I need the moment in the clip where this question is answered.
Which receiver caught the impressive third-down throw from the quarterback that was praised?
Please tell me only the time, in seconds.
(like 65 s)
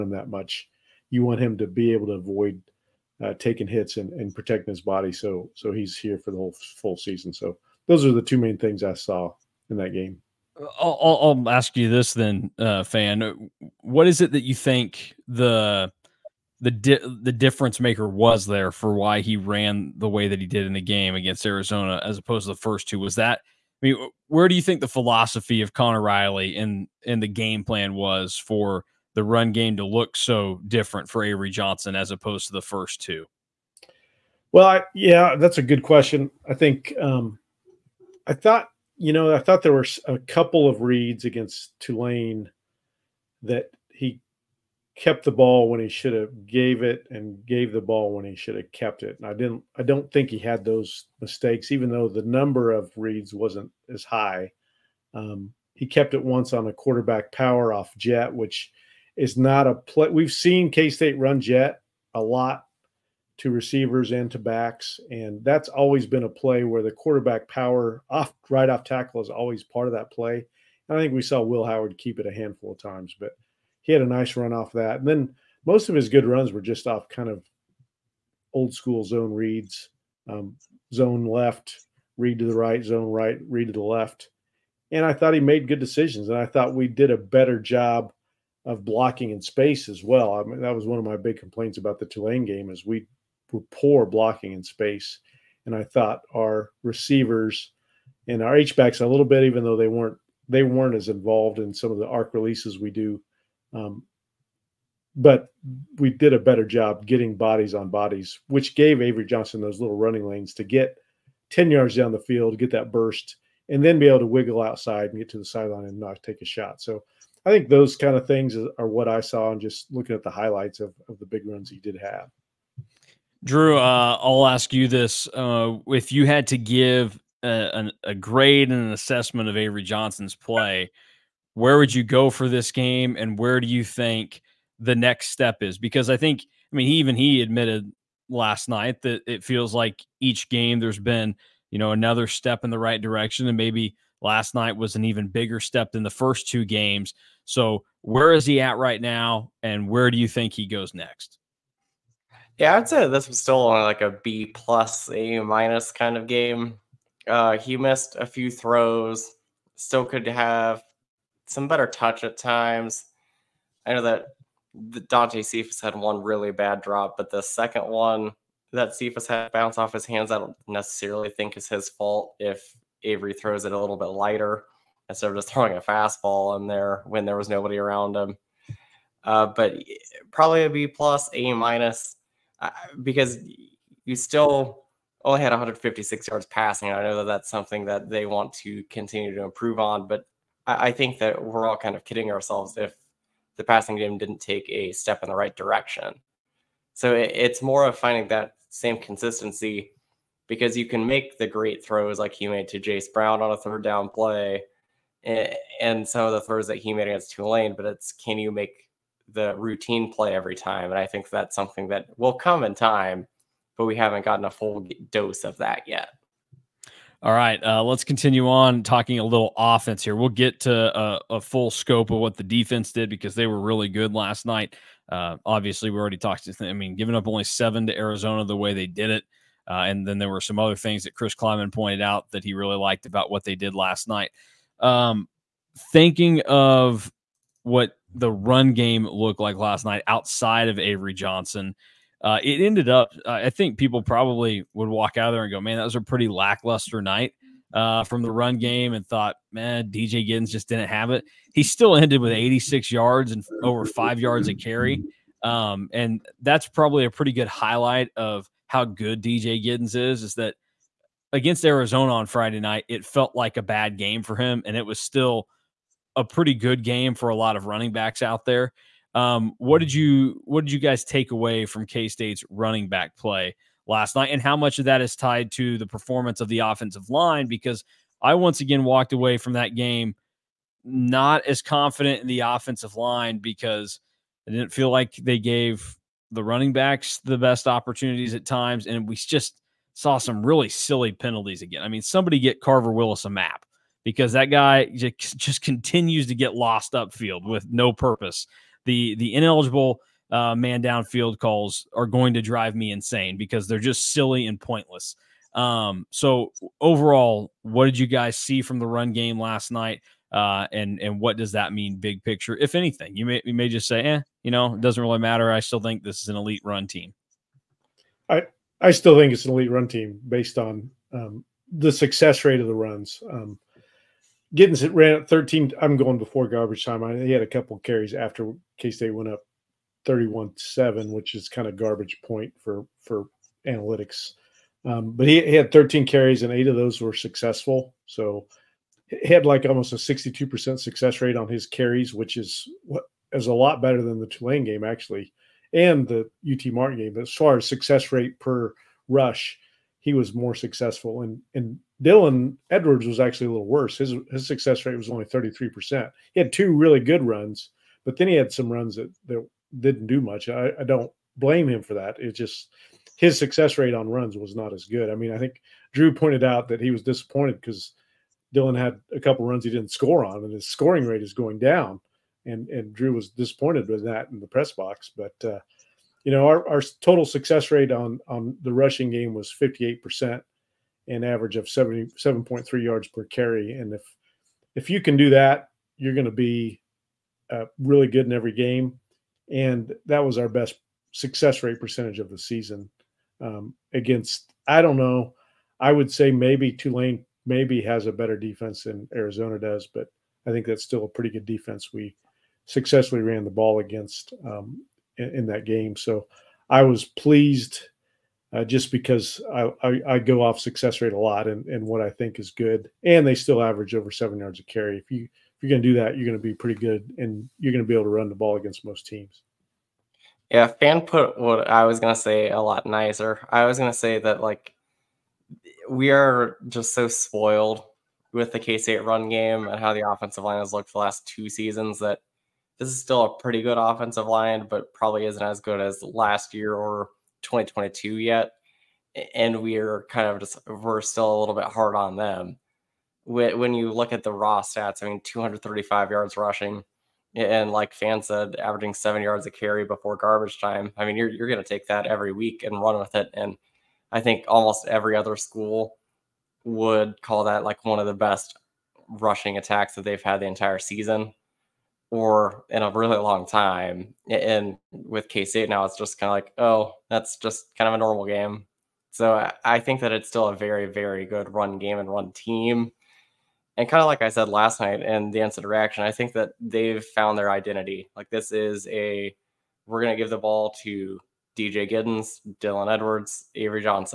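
202 s.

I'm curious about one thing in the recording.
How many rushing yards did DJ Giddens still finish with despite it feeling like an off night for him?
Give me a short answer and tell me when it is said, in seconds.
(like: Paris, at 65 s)
86, at 252 s.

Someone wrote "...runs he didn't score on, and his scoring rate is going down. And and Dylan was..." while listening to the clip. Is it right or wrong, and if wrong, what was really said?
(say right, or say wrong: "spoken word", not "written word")
wrong: "Drew", not "Dylan".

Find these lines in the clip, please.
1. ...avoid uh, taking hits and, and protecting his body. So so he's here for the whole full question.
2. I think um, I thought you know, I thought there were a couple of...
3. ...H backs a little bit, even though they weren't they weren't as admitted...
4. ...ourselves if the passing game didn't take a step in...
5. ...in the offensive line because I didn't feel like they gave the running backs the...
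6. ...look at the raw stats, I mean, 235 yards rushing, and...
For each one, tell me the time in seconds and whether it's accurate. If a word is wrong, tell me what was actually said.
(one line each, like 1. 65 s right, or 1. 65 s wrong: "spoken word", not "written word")
1. 2 s wrong: "season", not "question"
2. 36 s right
3. 98 s wrong: "involved", not "admitted"
4. 192 s right
5. 282 s right
6. 443 s right.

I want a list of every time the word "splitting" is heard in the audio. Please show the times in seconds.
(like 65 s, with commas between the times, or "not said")
not said.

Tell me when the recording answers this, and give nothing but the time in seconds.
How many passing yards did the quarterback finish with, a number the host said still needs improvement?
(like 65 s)
185 s.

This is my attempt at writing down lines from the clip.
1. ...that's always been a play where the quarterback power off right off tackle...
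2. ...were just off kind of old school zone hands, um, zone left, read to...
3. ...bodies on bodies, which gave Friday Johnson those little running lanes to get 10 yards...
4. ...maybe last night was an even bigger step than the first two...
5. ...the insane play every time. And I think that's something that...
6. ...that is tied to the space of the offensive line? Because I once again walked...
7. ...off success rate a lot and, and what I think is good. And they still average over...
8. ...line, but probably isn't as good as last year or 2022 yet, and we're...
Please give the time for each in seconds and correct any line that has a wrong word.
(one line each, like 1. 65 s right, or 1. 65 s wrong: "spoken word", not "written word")
1. 65 s right
2. 76 s wrong: "reads", not "hands"
3. 107 s wrong: "Avery", not "Friday"
4. 143 s right
5. 209 s wrong: "routine", not "insane"
6. 274 s wrong: "performance", not "space"
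7. 410 s right
8. 434 s right.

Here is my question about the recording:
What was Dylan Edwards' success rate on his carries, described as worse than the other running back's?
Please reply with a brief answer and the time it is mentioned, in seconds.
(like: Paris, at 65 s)
33%, at 355 s.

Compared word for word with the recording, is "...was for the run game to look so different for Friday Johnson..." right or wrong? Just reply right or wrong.
wrong.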